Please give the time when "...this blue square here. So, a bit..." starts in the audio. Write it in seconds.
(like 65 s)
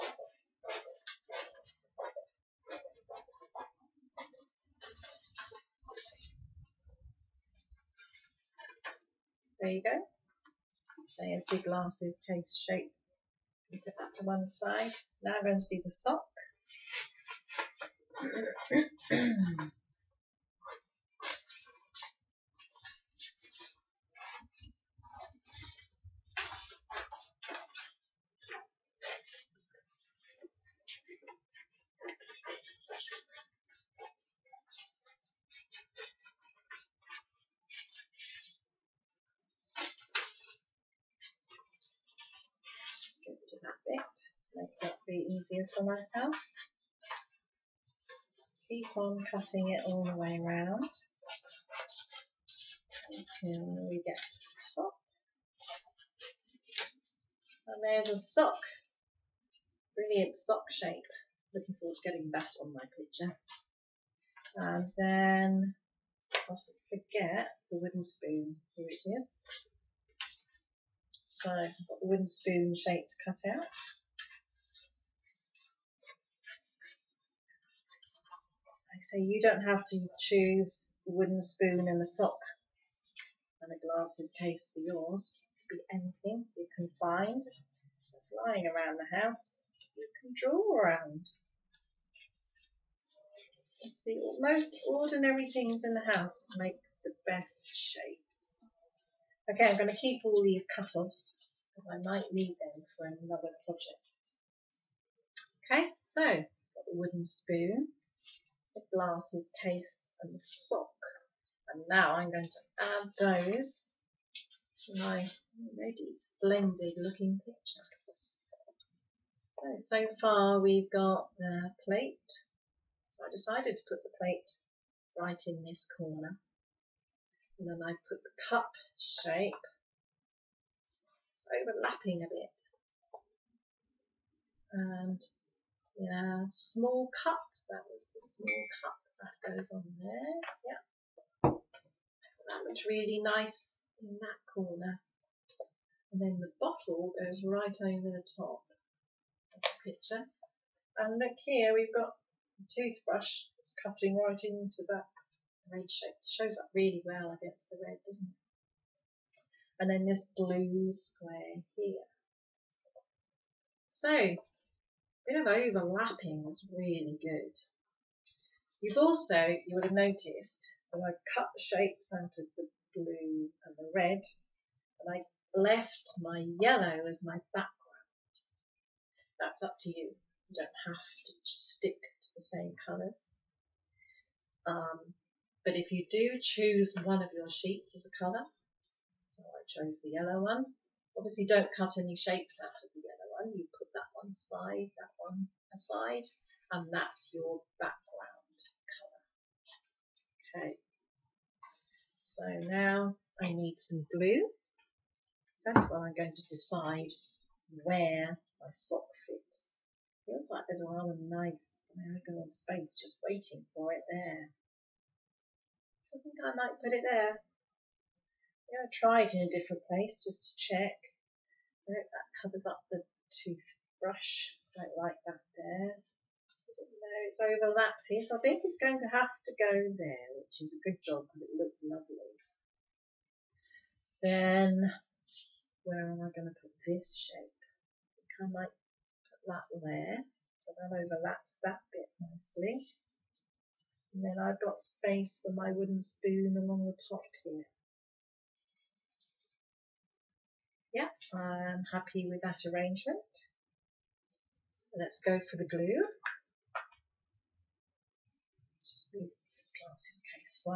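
160 s.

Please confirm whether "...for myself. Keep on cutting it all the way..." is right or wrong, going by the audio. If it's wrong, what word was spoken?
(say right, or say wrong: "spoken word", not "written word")
right.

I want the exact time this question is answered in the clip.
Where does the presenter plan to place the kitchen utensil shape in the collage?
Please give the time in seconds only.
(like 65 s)
246 s.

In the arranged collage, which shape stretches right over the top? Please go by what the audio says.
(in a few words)
The bottle.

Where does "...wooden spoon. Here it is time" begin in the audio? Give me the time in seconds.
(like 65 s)
67 s.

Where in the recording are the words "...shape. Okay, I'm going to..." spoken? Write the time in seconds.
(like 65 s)
97 s.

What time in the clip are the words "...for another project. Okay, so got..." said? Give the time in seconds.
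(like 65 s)
102 s.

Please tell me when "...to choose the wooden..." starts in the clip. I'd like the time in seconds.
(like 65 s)
79 s.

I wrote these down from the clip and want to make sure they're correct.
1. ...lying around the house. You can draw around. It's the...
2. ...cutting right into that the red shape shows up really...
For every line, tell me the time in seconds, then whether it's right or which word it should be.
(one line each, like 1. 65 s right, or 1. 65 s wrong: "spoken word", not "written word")
1. 88 s right
2. 153 s right.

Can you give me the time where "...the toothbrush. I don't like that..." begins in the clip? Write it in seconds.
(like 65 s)
222 s.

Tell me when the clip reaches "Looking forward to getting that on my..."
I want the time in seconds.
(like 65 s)
61 s.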